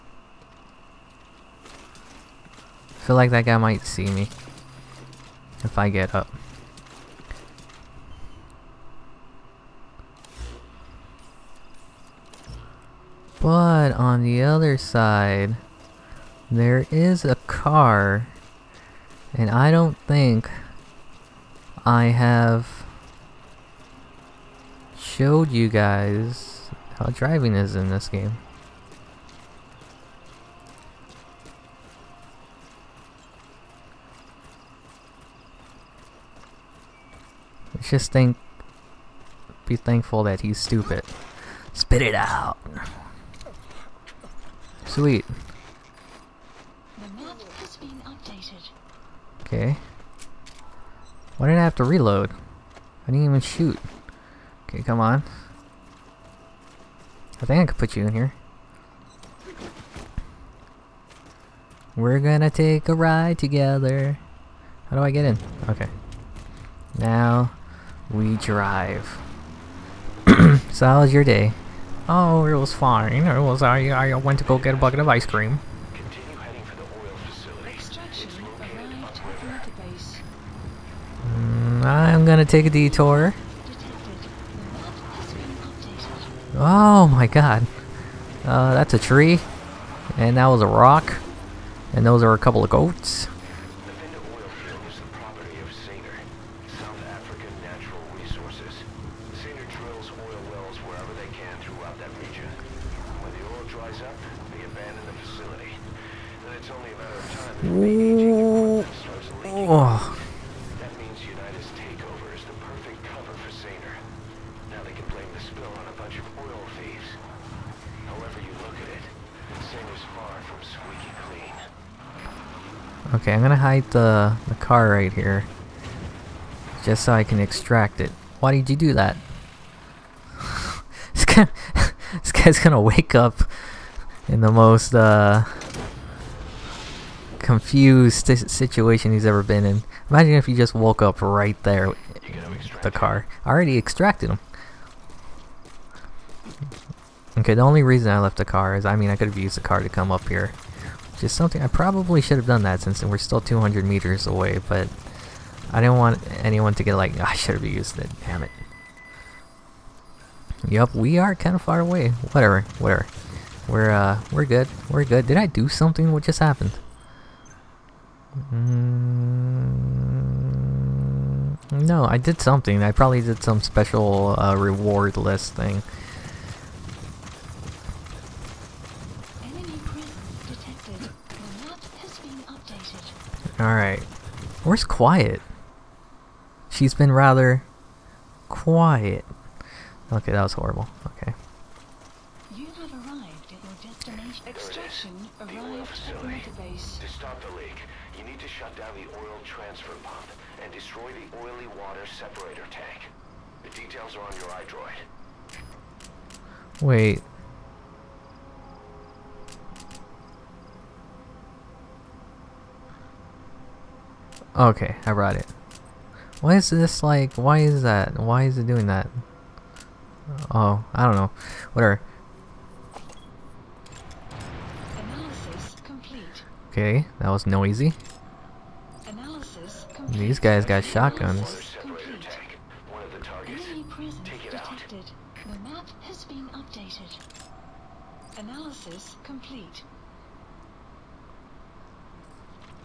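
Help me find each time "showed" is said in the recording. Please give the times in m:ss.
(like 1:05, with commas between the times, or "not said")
0:24.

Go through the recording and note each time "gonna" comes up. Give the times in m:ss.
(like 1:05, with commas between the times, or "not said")
1:02, 1:22, 2:03, 2:12.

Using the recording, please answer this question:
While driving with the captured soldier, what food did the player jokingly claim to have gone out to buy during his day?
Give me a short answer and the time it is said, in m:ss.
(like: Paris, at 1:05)
A bucket of ice cream, at 1:14.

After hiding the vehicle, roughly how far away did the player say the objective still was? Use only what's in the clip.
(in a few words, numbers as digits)
200 meters.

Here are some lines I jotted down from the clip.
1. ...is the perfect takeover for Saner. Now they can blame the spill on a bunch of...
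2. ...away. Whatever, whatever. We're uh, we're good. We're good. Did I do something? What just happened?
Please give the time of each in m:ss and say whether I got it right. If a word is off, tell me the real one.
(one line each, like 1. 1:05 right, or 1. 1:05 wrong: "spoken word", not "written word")
1. 1:52 wrong: "cover", not "takeover"
2. 2:41 right.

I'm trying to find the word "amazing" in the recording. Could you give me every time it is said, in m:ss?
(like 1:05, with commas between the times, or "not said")
not said.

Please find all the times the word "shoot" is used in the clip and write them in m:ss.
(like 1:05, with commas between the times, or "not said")
0:53.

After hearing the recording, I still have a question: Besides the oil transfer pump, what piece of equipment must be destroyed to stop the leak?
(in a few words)
Oily water separator tank.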